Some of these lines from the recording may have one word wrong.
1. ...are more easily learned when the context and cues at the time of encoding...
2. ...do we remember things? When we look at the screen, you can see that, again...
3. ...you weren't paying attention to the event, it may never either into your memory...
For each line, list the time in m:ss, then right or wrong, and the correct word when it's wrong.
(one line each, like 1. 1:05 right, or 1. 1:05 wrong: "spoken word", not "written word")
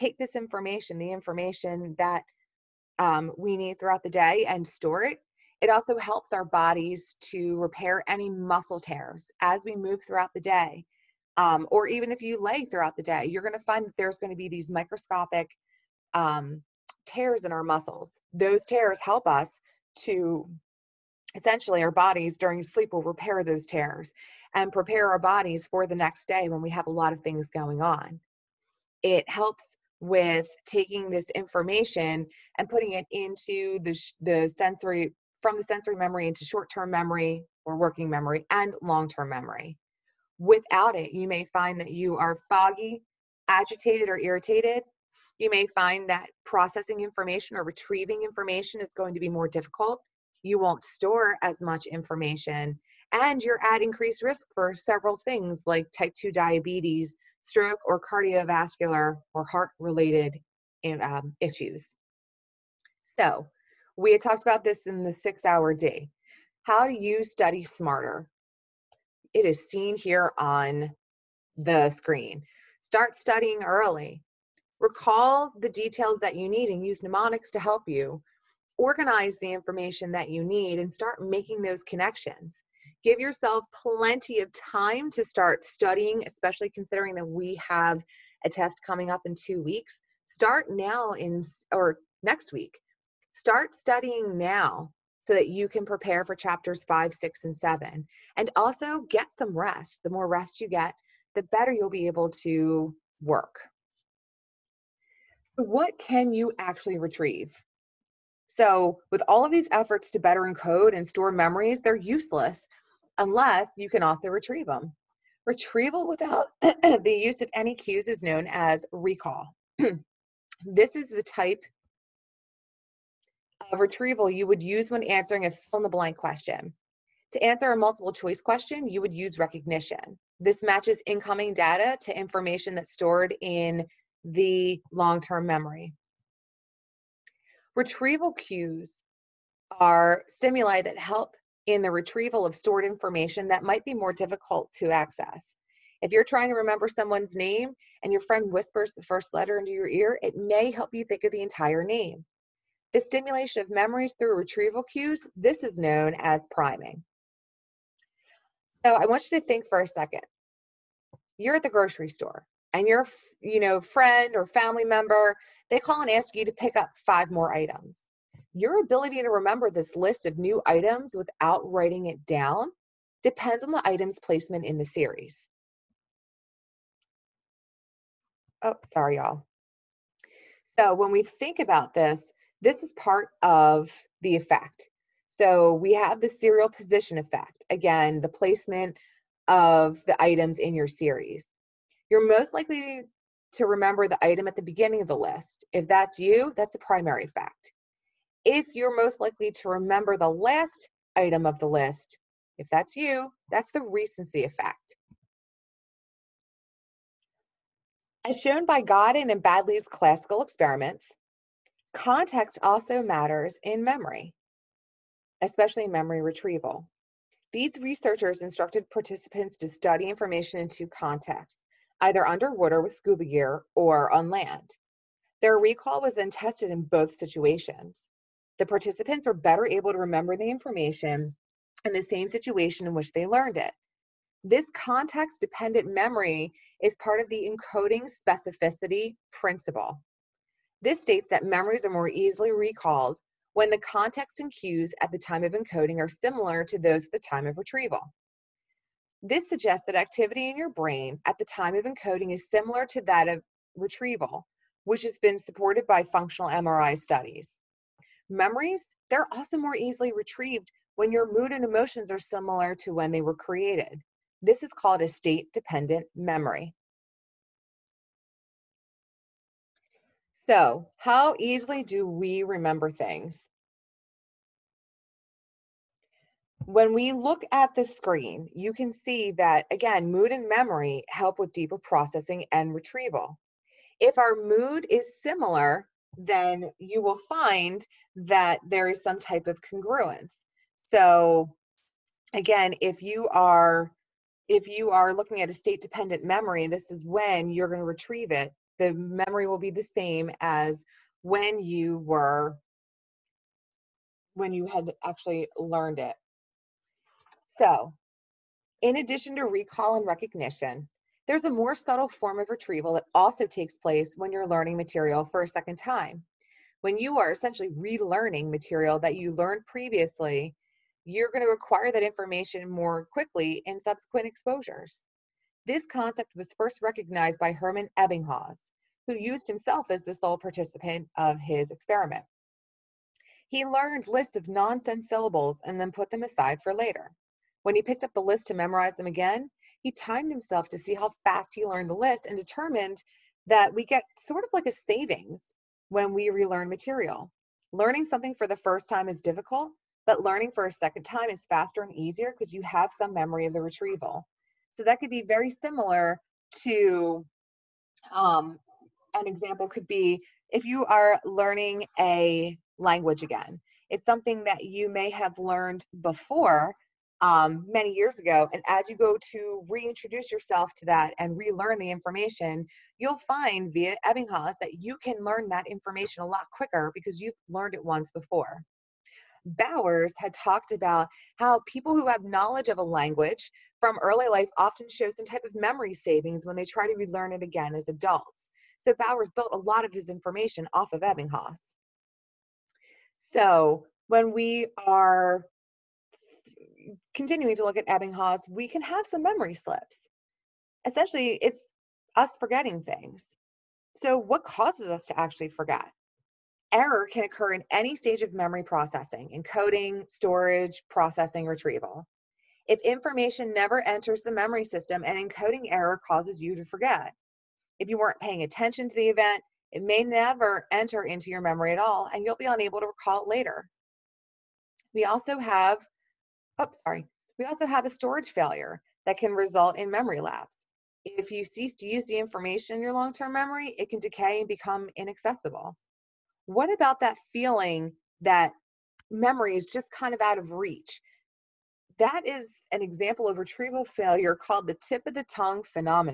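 1. 4:01 wrong: "recalled", not "learned"
2. 4:31 right
3. 6:57 wrong: "enter", not "either".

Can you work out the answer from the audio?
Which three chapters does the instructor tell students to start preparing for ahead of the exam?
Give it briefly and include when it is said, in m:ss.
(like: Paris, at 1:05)
5, 6, and 7, at 1:36.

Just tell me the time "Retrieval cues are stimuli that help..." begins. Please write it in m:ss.
2:17.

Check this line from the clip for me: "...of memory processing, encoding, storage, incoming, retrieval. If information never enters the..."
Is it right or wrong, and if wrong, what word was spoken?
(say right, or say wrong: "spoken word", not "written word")
wrong: "processing", not "incoming".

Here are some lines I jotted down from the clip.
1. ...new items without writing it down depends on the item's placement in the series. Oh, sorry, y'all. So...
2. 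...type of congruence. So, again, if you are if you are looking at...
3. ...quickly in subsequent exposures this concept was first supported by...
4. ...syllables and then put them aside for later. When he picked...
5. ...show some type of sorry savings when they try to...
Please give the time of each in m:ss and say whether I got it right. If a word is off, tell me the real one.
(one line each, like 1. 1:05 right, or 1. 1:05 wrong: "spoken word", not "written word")
1. 2:50 right
2. 4:49 right
3. 5:23 wrong: "recognized", not "supported"
4. 5:35 right
5. 6:24 wrong: "memory", not "sorry".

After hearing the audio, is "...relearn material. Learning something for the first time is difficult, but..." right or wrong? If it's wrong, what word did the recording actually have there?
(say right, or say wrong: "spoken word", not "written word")
right.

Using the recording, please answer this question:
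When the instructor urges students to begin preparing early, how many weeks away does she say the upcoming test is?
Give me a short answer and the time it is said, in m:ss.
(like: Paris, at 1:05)
2, at 1:29.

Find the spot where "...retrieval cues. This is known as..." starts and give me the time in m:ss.
2:34.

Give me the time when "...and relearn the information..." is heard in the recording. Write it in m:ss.
6:11.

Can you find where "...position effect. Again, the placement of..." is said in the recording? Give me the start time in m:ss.
3:06.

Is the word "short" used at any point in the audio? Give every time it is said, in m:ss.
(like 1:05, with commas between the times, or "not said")
0:36.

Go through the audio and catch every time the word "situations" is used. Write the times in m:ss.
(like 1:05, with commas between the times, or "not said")
3:47, 3:52.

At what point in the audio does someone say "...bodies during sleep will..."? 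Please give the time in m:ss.
0:21.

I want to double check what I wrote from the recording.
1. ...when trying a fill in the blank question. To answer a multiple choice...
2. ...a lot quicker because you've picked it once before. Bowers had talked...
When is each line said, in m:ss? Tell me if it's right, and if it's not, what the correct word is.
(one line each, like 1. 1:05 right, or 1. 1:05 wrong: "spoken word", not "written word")
1. 2:04 wrong: "answering", not "trying"
2. 6:16 wrong: "learned", not "picked".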